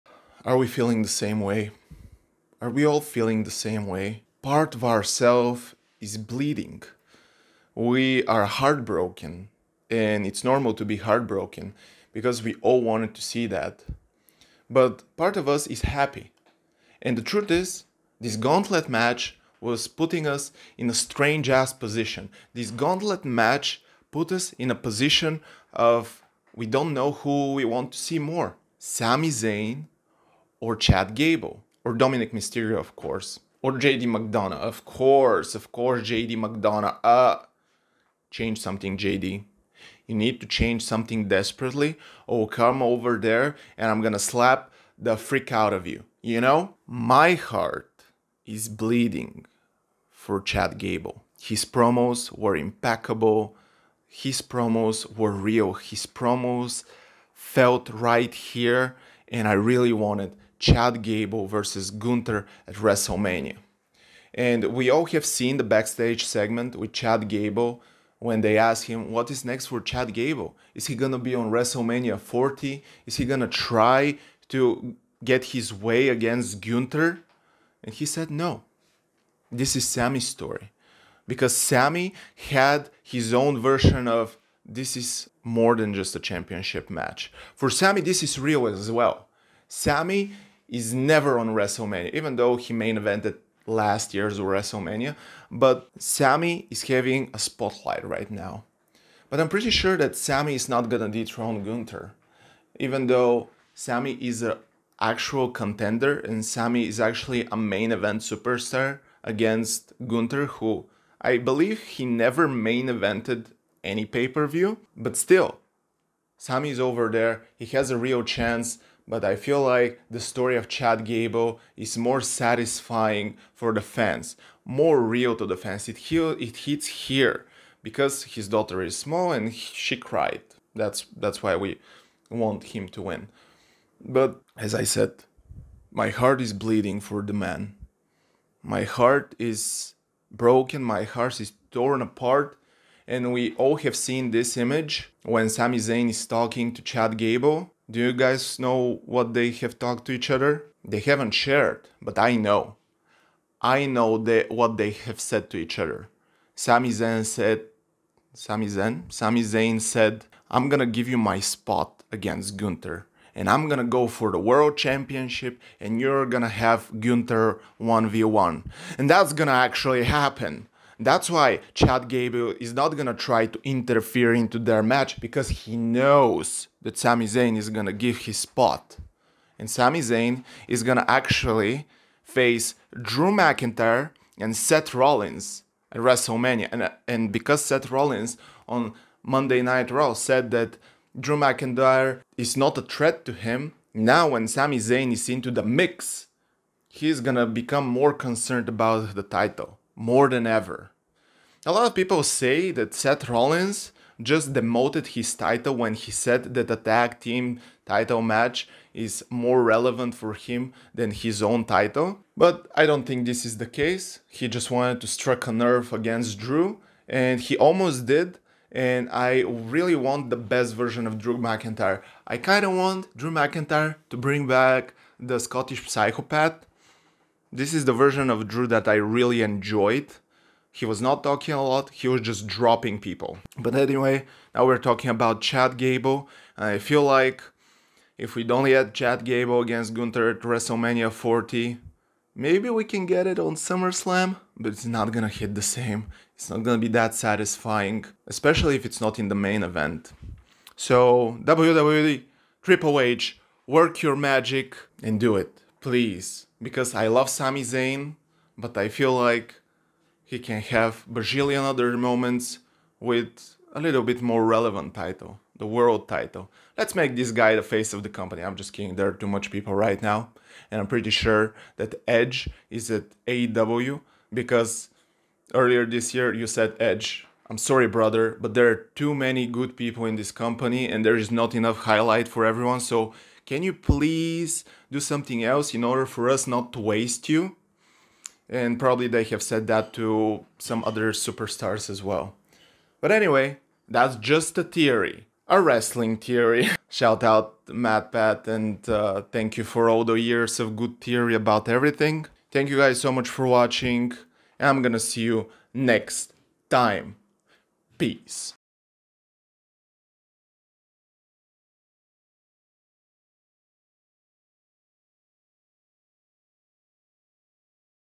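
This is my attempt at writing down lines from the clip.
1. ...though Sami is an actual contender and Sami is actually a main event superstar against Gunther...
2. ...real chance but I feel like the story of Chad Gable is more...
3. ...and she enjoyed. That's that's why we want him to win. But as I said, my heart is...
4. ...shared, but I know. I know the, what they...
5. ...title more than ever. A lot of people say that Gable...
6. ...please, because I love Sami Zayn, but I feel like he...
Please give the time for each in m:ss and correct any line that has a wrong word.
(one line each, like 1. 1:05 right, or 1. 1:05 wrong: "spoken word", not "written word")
1. 1:43 right
2. 1:57 right
3. 2:09 wrong: "cried", not "enjoyed"
4. 2:31 right
5. 3:19 wrong: "Seth", not "Gable"
6. 4:15 right.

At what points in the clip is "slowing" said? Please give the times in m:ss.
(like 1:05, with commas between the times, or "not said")
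not said.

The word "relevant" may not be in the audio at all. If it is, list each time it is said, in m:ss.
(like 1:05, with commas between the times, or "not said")
3:29, 4:24.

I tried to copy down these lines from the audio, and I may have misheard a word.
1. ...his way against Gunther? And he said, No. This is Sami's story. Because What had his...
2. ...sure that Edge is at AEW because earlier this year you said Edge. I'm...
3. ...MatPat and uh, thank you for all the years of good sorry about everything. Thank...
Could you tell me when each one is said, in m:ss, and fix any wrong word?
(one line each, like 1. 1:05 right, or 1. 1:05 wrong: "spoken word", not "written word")
1. 1:15 wrong: "Sami", not "What"
2. 4:31 right
3. 4:57 wrong: "theory", not "sorry".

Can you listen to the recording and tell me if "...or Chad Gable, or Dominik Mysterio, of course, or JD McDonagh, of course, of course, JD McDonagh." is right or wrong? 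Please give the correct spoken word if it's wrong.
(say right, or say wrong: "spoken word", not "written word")
right.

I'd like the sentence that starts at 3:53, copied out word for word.
But anyway, now we're talking about Chad Gable.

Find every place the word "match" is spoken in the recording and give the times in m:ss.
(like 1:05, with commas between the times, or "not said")
0:18, 0:23, 1:26, 2:54, 3:28.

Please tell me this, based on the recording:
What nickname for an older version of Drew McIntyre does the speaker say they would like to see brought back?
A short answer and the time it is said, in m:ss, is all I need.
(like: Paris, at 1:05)
Scottish psychopath, at 3:45.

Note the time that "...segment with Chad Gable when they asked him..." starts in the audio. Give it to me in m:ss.
1:06.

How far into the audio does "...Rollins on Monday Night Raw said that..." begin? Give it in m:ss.
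3:07.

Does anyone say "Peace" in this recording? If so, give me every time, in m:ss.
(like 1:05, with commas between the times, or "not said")
5:07.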